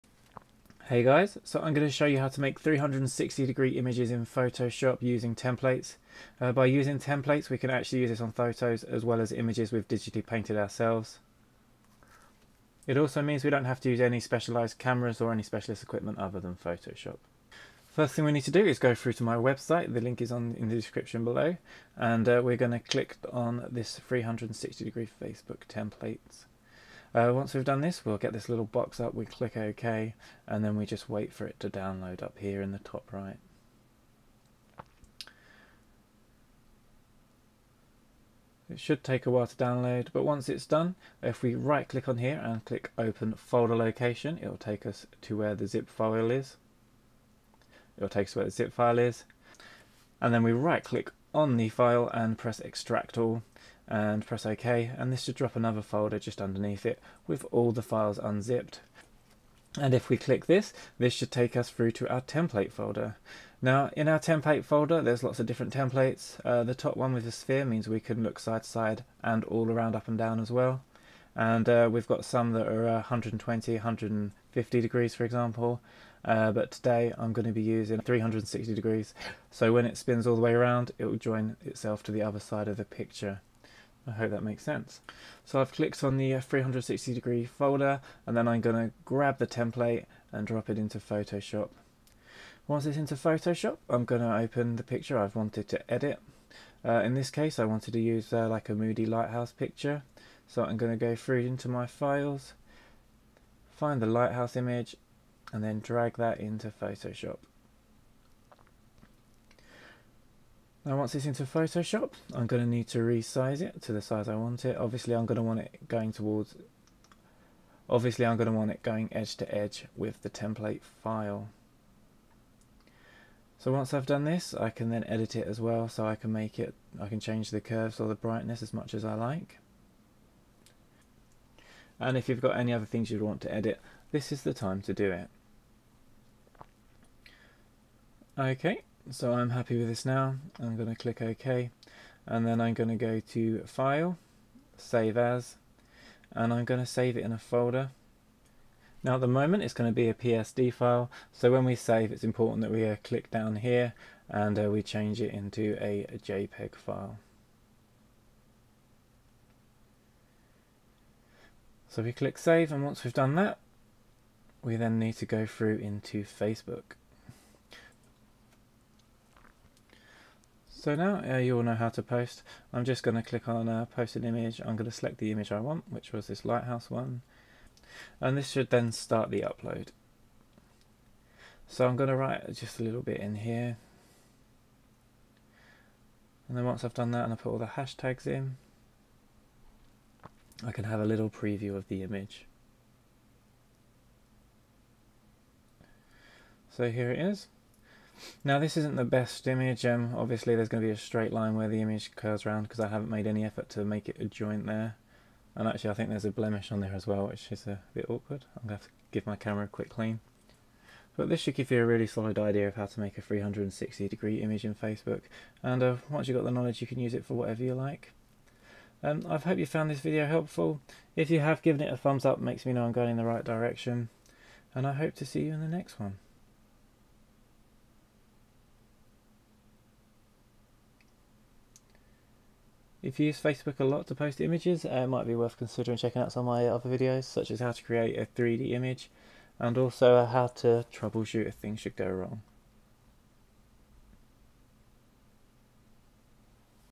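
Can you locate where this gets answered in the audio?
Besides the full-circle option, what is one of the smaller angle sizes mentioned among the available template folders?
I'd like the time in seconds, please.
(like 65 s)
72 s.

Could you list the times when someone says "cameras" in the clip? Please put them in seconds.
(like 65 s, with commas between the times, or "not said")
14 s, 209 s.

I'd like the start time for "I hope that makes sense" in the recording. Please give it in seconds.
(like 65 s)
84 s.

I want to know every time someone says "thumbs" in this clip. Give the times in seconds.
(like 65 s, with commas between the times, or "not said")
221 s.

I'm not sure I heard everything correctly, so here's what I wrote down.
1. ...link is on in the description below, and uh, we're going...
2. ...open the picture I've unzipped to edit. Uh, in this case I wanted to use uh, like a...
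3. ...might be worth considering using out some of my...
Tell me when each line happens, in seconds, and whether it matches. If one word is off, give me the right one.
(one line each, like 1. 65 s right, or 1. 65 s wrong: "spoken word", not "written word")
1. 20 s right
2. 94 s wrong: "wanted", not "unzipped"
3. 235 s wrong: "checking", not "using".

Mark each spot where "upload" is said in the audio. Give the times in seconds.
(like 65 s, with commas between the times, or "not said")
179 s.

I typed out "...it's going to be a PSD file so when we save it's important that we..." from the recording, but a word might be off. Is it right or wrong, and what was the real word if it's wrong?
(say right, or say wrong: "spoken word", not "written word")
right.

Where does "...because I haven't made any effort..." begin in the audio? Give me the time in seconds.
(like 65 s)
202 s.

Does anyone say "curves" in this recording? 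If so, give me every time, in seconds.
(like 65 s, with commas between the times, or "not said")
127 s, 202 s.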